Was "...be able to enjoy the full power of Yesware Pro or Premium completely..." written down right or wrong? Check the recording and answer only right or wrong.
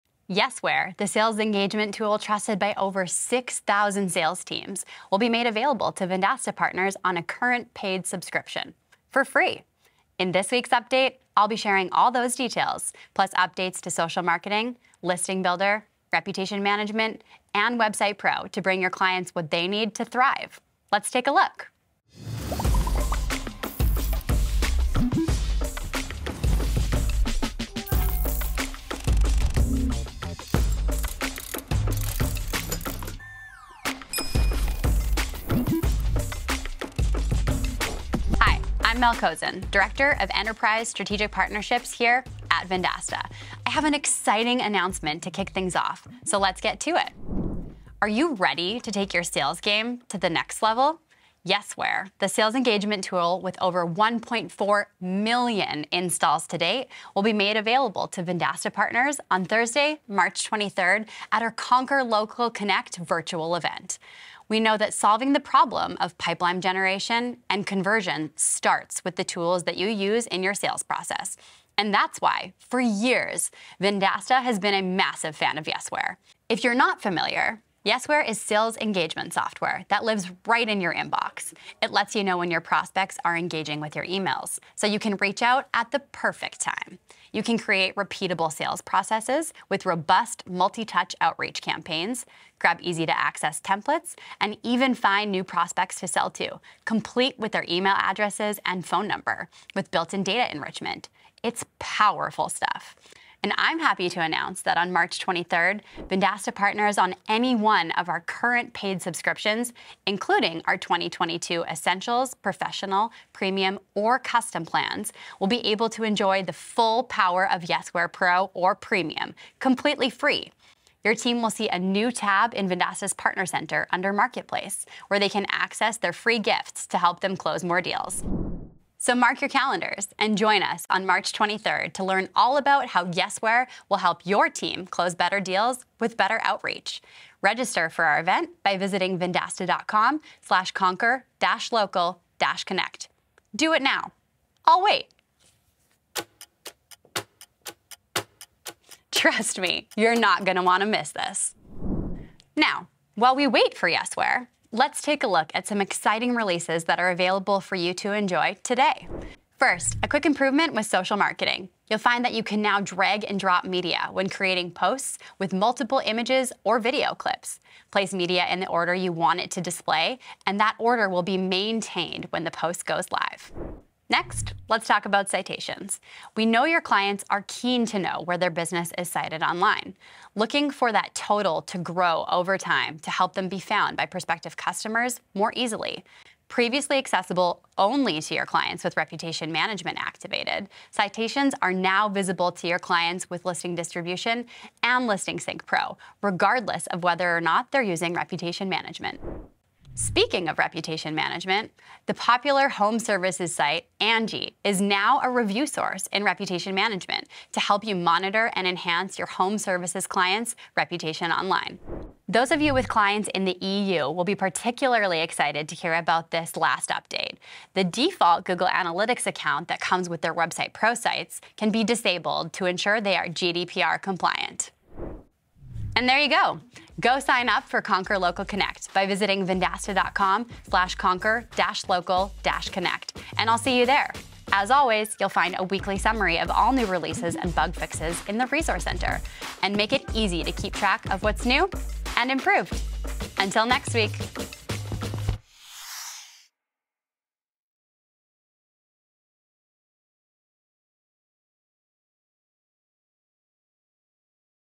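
right.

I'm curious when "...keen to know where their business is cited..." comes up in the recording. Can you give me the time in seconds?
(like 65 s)
177 s.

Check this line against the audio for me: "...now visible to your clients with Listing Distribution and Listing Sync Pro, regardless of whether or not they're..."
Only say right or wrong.
right.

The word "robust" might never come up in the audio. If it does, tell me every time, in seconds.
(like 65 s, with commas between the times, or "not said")
89 s.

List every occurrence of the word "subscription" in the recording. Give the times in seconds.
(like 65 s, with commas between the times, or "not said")
8 s, 109 s.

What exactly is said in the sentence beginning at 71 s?
And that's why, for years, Vendasta has been a massive fan of Yesware.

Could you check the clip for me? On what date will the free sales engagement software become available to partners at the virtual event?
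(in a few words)
March 23rd.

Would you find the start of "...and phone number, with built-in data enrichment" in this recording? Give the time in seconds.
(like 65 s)
98 s.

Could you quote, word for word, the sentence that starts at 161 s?
You'll find that you can now drag and drop media when creating posts with multiple images or video clips.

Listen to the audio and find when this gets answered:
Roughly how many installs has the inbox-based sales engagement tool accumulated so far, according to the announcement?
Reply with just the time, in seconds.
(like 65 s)
53 s.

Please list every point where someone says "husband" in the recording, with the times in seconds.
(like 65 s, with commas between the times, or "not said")
not said.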